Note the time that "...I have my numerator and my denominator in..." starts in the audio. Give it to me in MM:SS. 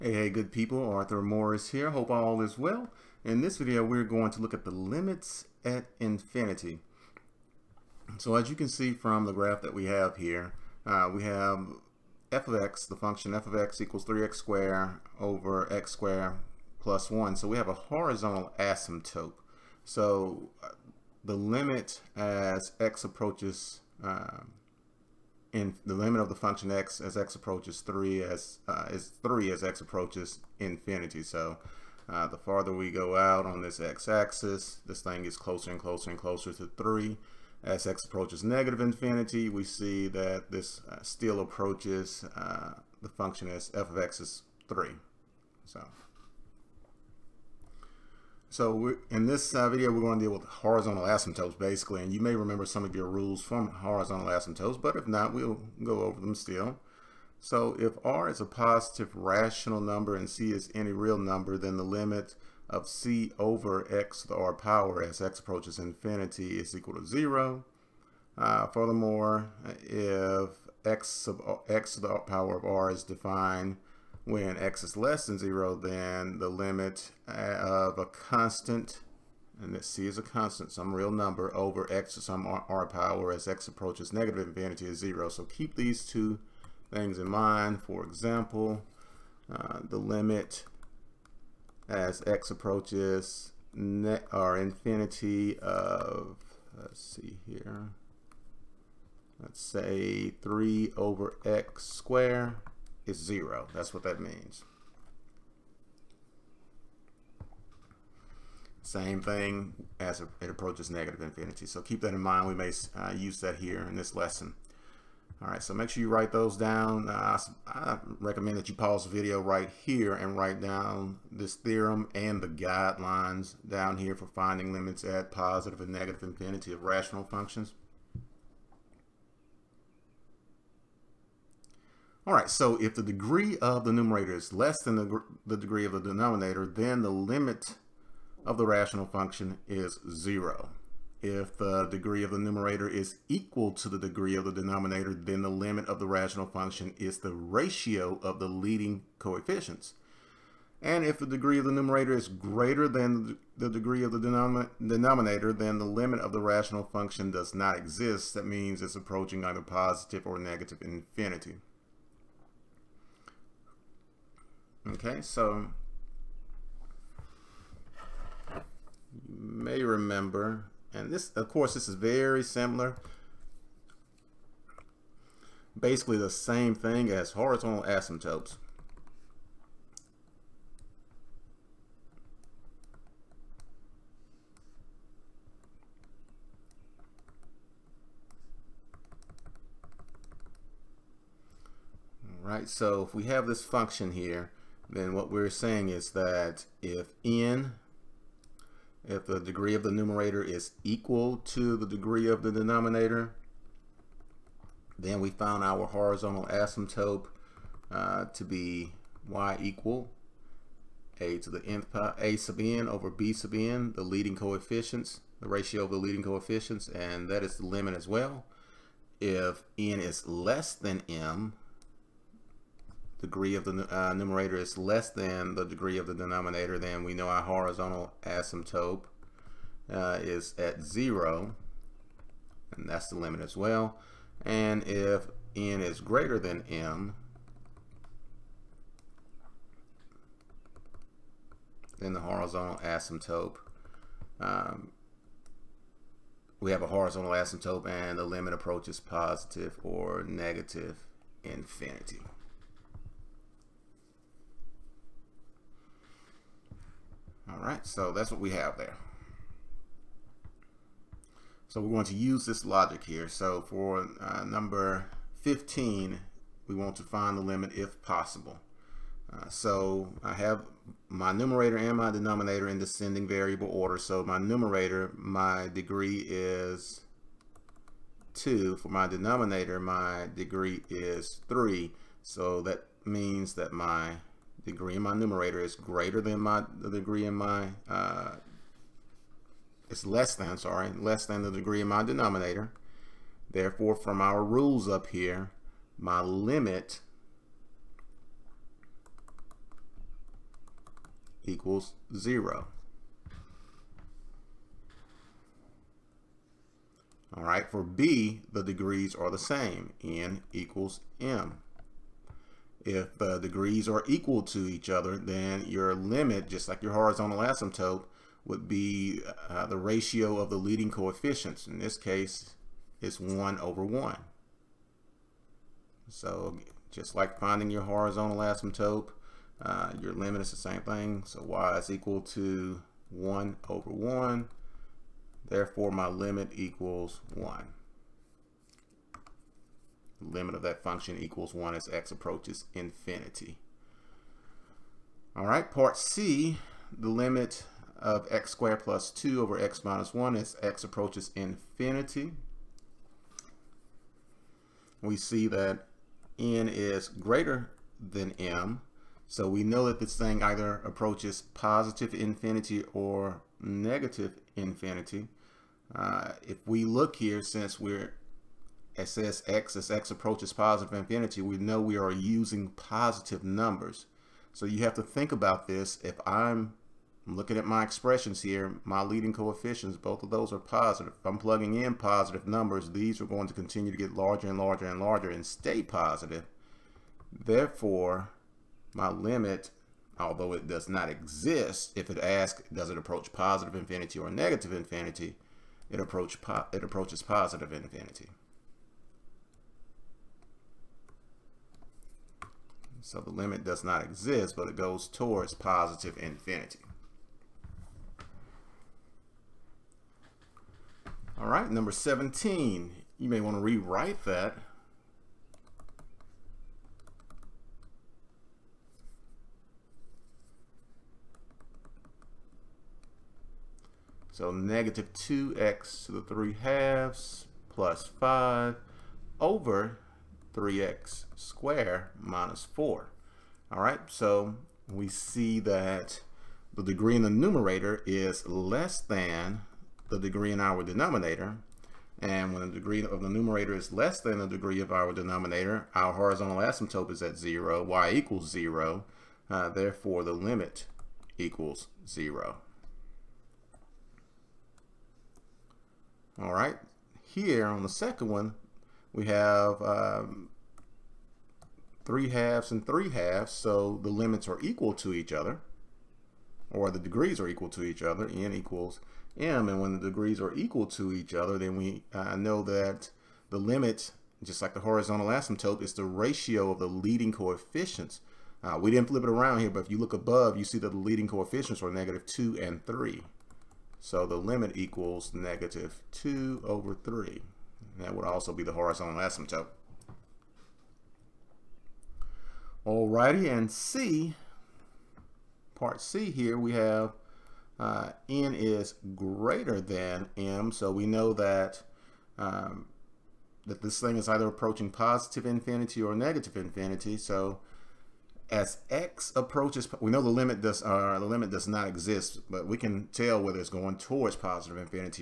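04:30.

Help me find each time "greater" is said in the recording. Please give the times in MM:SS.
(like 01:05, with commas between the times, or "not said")
02:32, 03:55, 04:45, 05:57, 08:19.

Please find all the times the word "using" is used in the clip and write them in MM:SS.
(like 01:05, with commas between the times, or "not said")
06:12.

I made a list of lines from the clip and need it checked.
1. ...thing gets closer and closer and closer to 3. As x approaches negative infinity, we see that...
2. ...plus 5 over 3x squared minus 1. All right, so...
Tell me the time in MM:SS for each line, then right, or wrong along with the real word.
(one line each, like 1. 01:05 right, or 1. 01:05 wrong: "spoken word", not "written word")
1. 00:35 right
2. 07:07 wrong: "4", not "1".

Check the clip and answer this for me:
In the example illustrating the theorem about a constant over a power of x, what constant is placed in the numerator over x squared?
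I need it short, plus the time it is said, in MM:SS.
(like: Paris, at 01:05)
3, at 01:40.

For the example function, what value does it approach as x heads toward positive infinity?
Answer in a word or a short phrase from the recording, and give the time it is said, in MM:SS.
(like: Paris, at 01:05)
3, at 00:28.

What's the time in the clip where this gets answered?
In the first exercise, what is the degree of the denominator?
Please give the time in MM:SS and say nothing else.
04:39.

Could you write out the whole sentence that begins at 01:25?
So keep these two things in mind.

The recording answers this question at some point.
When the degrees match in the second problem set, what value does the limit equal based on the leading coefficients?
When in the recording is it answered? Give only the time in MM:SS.
08:05.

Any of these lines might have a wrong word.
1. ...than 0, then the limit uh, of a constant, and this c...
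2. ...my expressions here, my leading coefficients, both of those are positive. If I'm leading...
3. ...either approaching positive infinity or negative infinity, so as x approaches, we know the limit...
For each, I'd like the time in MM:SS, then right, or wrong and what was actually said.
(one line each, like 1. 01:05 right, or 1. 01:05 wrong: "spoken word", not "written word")
1. 01:15 right
2. 06:17 wrong: "plugging", not "leading"
3. 08:24 right.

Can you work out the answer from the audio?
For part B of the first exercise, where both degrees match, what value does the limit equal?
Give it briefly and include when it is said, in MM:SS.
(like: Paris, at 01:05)
1, at 05:35.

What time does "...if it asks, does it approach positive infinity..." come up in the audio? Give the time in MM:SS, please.
06:31.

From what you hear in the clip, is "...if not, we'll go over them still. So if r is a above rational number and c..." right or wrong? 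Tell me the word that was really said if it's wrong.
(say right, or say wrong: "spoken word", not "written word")
wrong: "positive", not "above".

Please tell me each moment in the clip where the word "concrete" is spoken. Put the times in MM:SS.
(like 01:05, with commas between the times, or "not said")
not said.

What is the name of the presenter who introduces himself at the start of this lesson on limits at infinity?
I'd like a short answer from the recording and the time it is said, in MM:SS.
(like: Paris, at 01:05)
Arthur Morris, at 00:00.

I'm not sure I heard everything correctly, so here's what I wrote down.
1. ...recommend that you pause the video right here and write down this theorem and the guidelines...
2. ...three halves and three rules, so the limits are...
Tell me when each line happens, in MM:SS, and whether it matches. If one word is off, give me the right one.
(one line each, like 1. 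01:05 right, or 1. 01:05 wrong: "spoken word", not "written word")
1. 01:58 right
2. 07:42 wrong: "halves", not "rules".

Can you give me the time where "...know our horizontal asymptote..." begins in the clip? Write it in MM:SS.
03:47.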